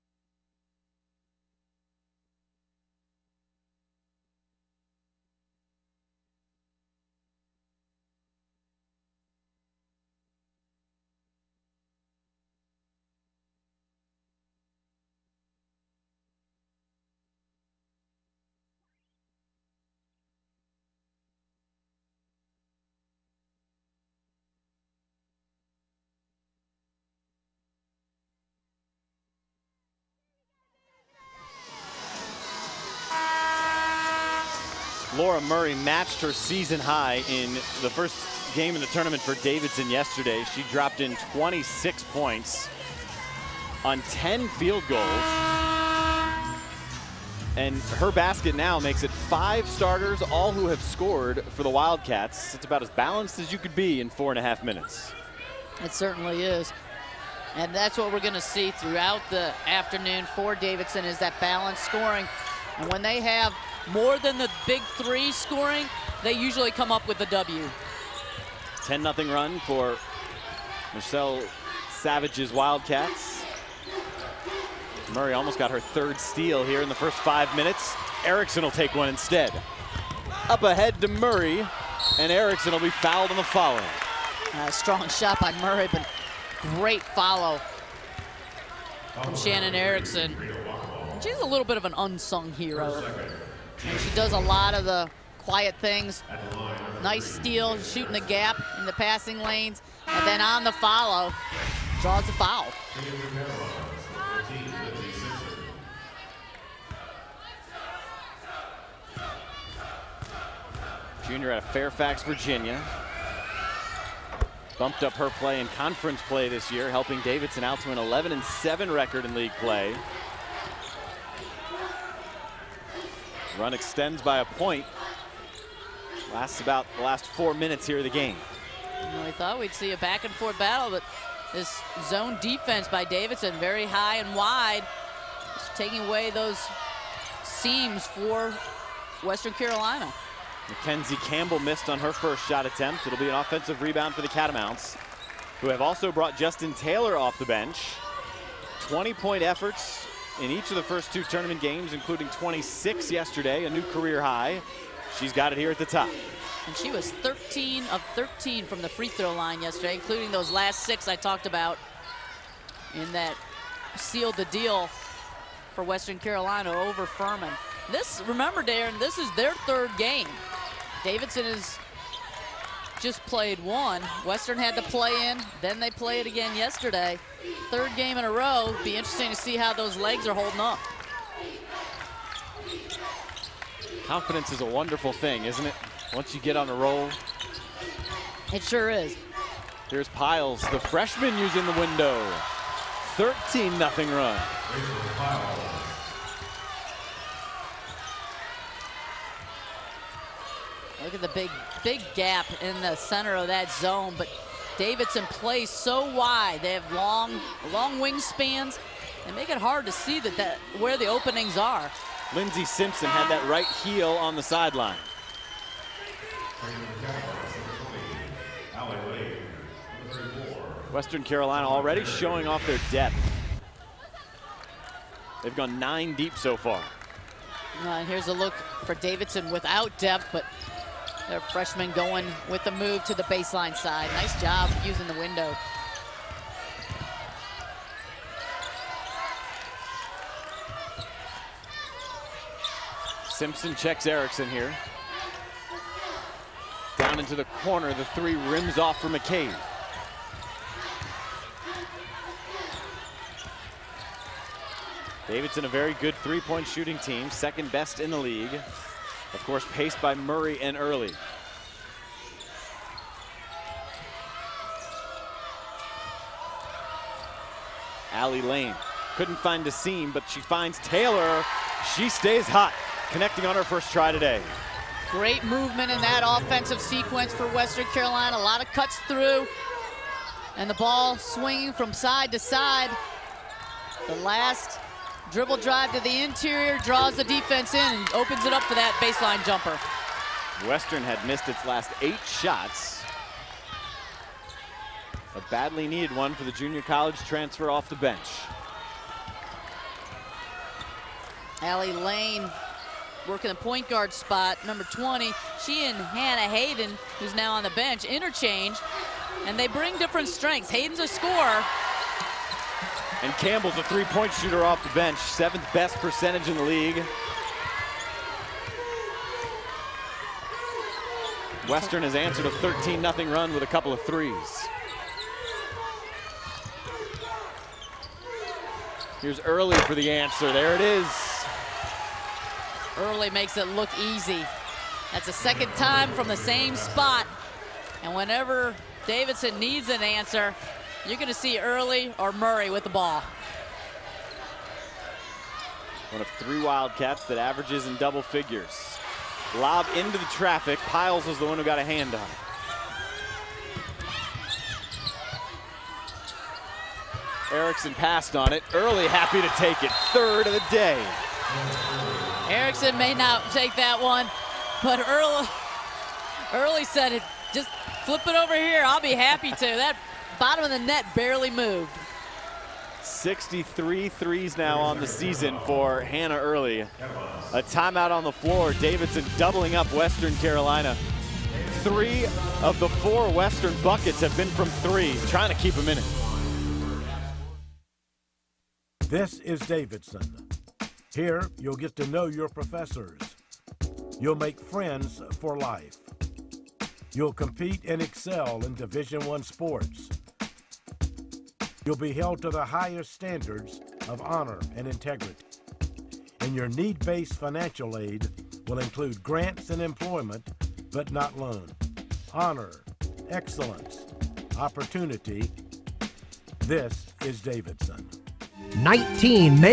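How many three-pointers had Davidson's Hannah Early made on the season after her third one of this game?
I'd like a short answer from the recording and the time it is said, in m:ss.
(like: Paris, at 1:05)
63, at 6:13.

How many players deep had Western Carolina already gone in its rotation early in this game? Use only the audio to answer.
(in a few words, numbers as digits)
9.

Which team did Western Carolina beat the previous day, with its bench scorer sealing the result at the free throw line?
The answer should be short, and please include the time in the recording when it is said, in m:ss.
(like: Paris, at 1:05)
Furman, at 2:47.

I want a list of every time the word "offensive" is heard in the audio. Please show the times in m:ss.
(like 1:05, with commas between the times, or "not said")
2:23, 4:36.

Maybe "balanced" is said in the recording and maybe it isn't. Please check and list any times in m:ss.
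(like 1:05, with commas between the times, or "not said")
0:52, 1:01.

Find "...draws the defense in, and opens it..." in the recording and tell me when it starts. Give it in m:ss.
4:46.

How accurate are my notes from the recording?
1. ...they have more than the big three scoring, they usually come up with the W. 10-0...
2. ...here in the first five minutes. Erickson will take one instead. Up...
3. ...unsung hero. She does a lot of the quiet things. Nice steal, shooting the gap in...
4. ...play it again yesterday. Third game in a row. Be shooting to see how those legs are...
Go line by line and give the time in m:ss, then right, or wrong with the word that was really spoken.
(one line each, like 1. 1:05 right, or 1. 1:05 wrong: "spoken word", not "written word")
1. 1:03 right
2. 1:16 right
3. 1:31 right
4. 2:55 wrong: "interesting", not "shooting".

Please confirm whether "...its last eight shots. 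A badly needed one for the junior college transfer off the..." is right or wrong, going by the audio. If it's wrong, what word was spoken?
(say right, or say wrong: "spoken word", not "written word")
right.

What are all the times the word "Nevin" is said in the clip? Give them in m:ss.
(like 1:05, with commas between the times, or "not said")
not said.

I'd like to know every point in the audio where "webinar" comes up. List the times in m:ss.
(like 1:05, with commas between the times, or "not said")
not said.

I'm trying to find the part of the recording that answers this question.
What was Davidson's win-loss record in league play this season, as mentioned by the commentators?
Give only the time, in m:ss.
1:57.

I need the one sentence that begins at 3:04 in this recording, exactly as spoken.
Confidence is a wonderful thing, isn't it?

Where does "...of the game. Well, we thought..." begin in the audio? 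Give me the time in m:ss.
2:07.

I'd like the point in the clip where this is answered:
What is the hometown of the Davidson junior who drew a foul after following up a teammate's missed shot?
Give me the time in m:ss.
1:51.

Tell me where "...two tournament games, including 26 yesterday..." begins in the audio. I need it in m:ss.
2:31.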